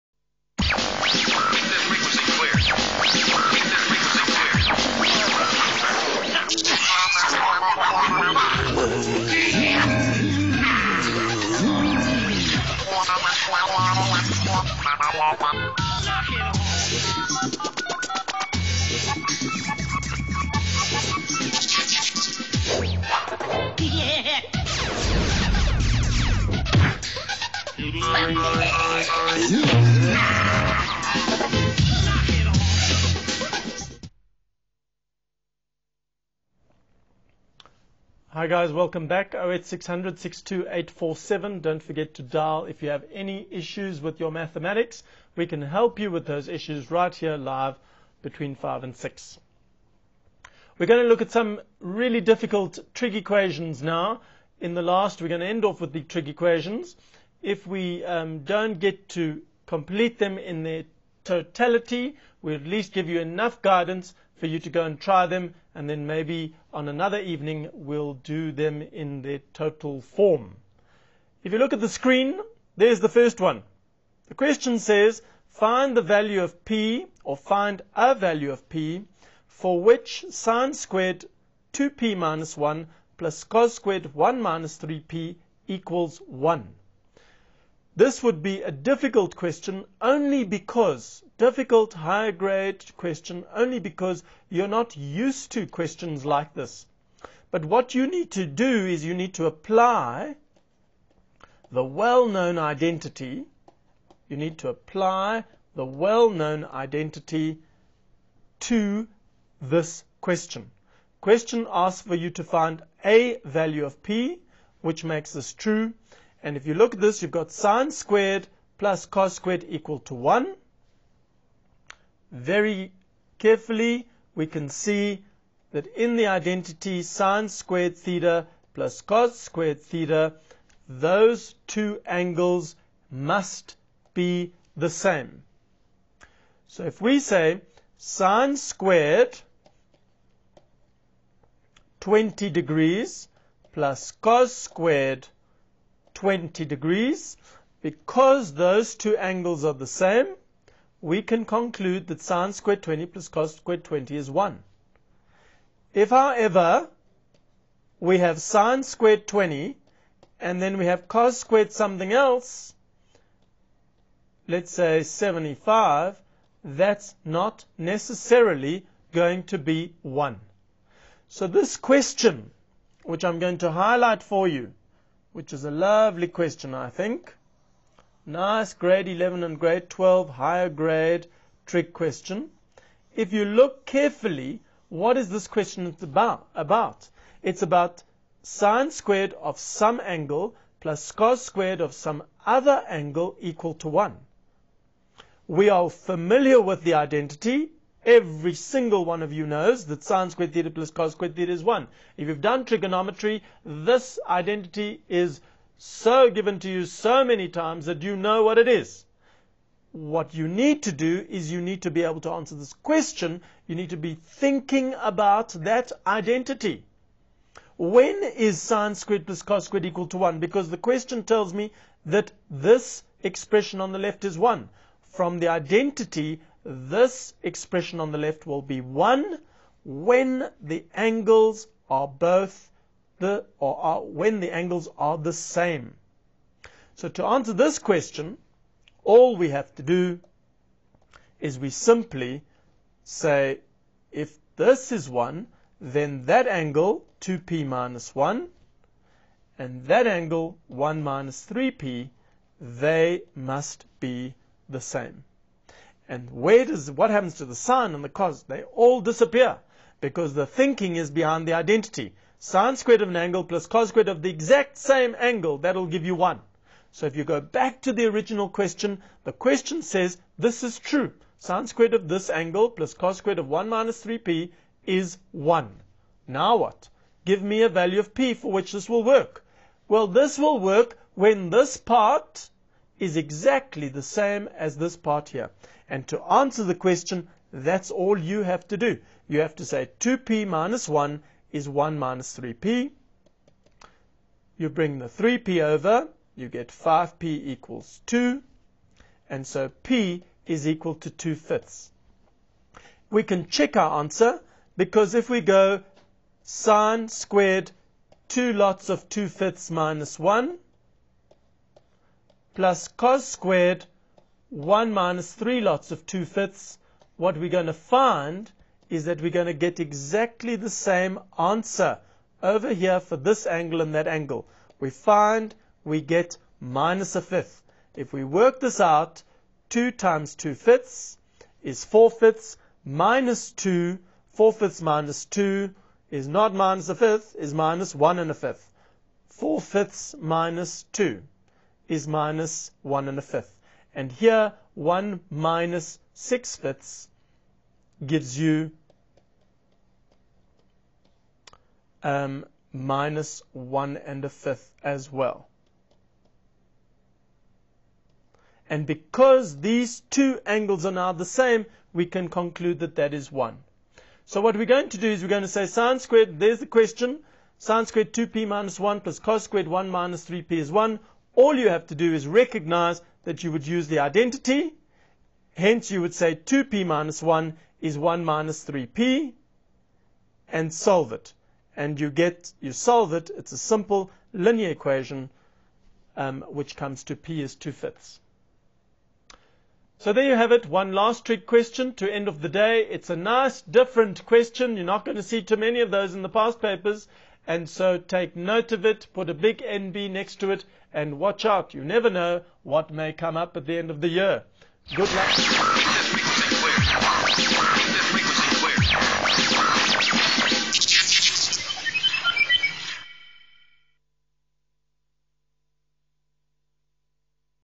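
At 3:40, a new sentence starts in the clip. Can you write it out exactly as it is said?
Because the question tells me that this expression on the left is 1.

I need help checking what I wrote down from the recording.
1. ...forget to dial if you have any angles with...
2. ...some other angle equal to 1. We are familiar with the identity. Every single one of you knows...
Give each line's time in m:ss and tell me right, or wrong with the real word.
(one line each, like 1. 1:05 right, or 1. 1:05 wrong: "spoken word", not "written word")
1. 0:41 wrong: "issues", not "angles"
2. 3:11 right.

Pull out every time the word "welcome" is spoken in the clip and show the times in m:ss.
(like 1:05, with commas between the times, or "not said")
0:38.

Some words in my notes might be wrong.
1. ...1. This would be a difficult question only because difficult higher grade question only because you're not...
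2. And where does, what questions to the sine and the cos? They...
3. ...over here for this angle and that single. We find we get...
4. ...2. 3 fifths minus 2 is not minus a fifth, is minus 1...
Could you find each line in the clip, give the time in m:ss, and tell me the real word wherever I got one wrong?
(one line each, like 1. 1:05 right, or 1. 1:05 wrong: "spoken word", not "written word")
1. 1:26 right
2. 4:16 wrong: "happens", not "questions"
3. 5:22 wrong: "angle", not "single"
4. 5:33 wrong: "4", not "3".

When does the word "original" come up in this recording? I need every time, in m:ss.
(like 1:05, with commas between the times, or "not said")
4:28.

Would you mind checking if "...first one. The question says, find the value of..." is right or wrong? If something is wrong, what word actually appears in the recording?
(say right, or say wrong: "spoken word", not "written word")
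right.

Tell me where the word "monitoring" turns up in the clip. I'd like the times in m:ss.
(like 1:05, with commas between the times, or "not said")
not said.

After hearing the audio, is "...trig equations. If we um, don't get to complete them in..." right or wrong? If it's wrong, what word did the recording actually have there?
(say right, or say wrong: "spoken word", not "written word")
right.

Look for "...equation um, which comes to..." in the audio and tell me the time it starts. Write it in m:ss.
6:24.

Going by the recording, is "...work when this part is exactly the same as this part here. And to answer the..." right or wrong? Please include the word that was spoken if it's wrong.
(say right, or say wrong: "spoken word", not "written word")
right.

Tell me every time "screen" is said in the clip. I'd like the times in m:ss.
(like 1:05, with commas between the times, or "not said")
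1:11.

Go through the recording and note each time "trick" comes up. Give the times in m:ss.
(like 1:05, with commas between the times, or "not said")
3:01, 6:31.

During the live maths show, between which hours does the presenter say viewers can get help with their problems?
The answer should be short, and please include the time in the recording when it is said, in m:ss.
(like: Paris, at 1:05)
5 and 6, at 0:48.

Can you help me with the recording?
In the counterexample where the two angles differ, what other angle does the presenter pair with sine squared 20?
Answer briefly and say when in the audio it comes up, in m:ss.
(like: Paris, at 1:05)
75, at 2:45.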